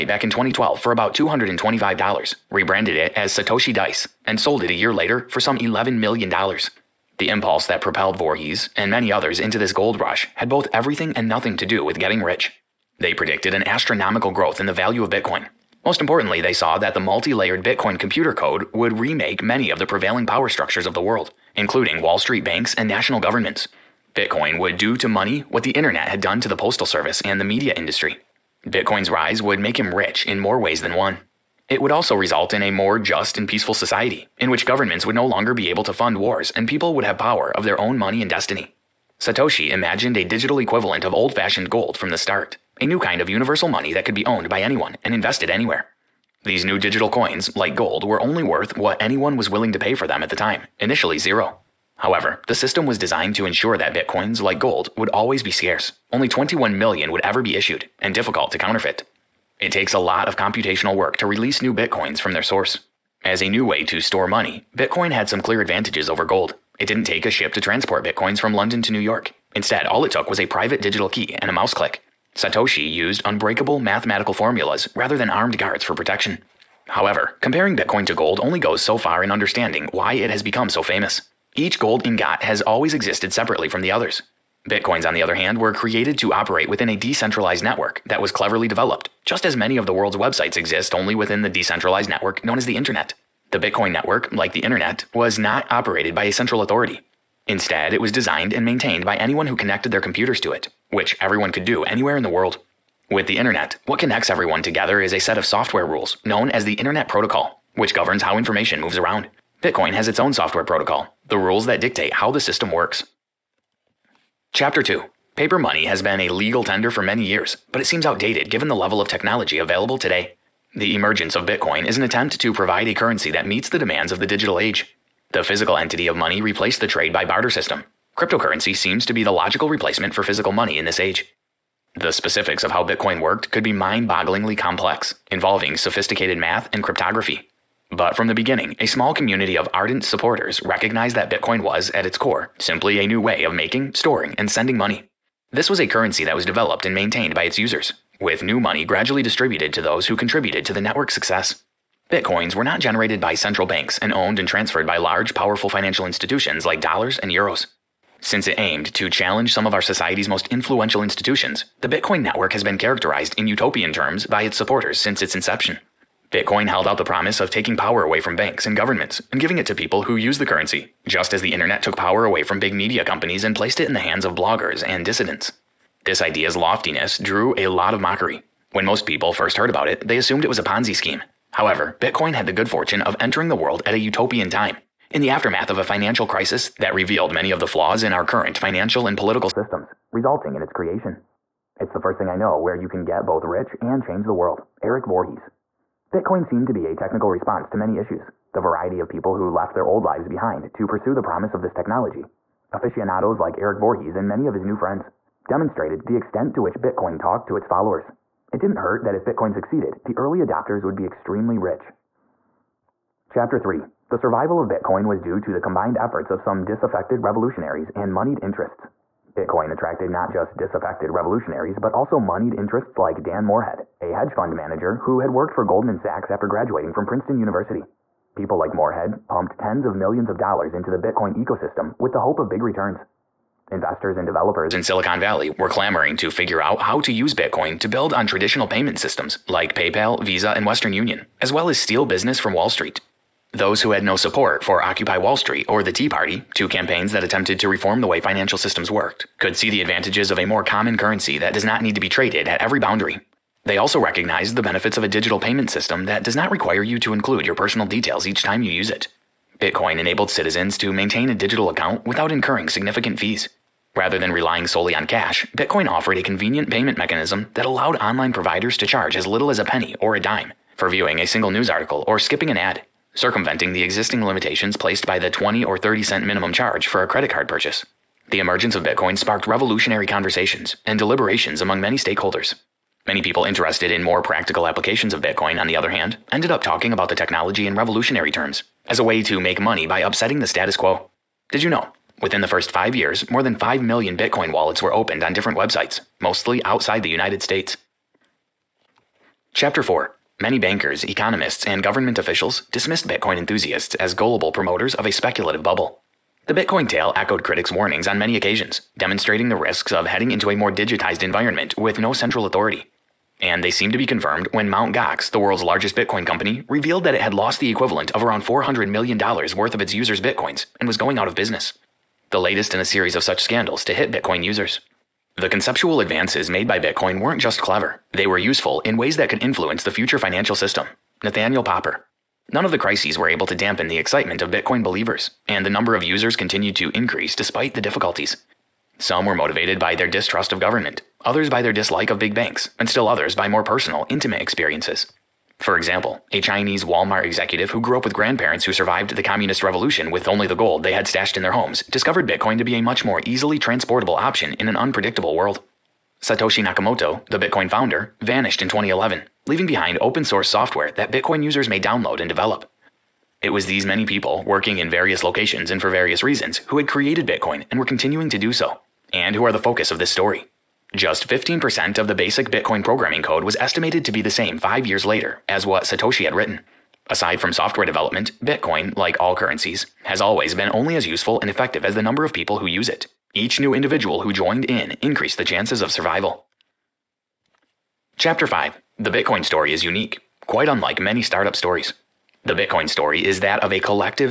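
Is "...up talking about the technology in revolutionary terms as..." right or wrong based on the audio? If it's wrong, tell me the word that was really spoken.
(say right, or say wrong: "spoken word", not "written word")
right.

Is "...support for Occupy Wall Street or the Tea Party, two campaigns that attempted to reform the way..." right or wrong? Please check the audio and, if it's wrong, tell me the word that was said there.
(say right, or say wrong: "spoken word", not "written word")
right.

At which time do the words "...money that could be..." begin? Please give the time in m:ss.
0:43.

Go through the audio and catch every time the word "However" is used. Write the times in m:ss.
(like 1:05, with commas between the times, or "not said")
0:51, 1:16, 3:01.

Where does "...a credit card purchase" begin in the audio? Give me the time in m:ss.
4:37.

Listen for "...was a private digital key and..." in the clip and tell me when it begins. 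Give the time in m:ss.
1:10.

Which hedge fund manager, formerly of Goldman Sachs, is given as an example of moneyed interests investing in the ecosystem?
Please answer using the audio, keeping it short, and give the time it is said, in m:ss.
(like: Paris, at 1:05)
Dan Morehead, at 3:43.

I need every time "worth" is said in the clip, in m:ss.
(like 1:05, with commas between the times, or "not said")
0:48, 5:19.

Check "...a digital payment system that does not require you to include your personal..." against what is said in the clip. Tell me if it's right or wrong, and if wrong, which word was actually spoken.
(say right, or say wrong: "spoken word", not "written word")
right.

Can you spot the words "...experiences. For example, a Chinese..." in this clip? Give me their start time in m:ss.
5:44.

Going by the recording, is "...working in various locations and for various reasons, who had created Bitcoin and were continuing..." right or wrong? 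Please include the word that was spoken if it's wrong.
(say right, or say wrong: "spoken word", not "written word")
right.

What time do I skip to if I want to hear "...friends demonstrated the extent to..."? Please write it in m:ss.
3:24.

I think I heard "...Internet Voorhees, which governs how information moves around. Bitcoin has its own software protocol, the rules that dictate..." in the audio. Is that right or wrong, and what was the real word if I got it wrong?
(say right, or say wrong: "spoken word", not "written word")
wrong: "Protocol", not "Voorhees".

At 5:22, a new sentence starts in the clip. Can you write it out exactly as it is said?
The latest in a series of such scandals to hit Bitcoin users.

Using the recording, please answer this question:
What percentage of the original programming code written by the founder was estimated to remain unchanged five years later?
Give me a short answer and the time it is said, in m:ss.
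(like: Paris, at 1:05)
15%, at 6:11.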